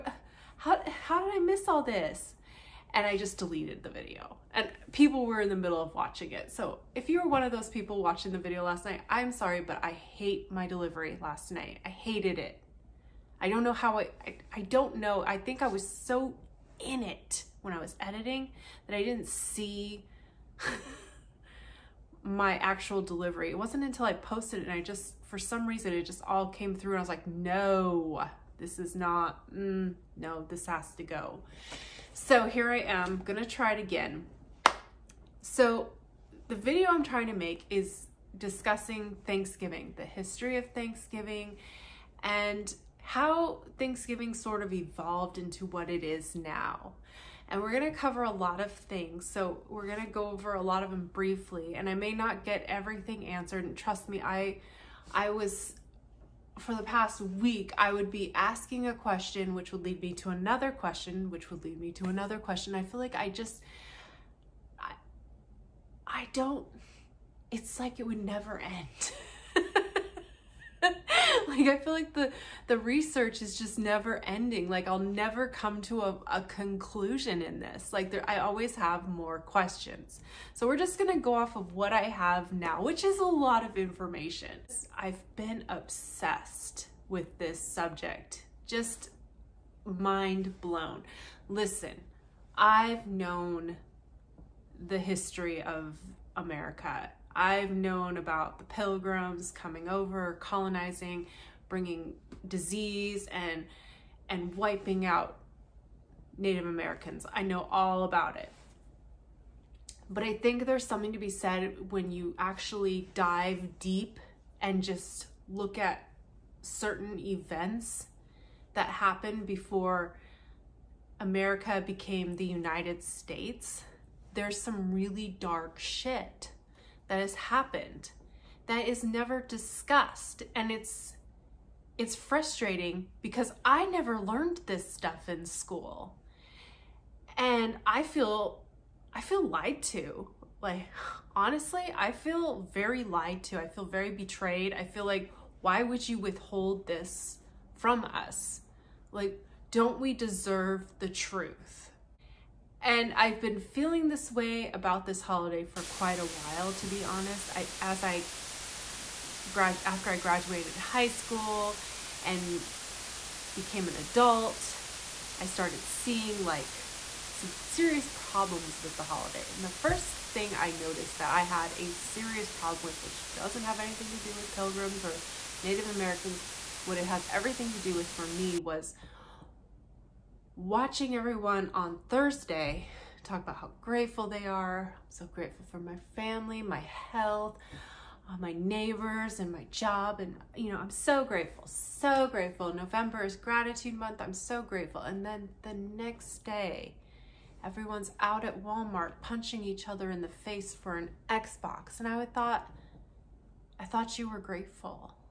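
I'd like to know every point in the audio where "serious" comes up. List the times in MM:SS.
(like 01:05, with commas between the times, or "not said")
02:47, 02:51.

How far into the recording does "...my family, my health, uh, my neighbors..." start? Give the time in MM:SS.
03:05.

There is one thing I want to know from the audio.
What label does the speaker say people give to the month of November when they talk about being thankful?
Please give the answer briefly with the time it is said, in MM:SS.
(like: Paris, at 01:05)
Gratitude month, at 03:13.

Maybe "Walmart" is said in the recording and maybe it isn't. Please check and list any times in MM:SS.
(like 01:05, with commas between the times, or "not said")
03:18.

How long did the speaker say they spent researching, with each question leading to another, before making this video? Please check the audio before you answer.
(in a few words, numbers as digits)
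The past week.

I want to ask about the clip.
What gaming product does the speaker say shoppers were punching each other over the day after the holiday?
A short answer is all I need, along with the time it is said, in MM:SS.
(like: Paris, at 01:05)
An Xbox, at 03:20.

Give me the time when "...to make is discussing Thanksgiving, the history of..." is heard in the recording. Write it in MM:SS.
00:37.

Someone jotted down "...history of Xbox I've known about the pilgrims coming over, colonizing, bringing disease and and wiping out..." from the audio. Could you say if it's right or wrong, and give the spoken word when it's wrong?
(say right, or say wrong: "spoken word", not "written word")
wrong: "America", not "Xbox".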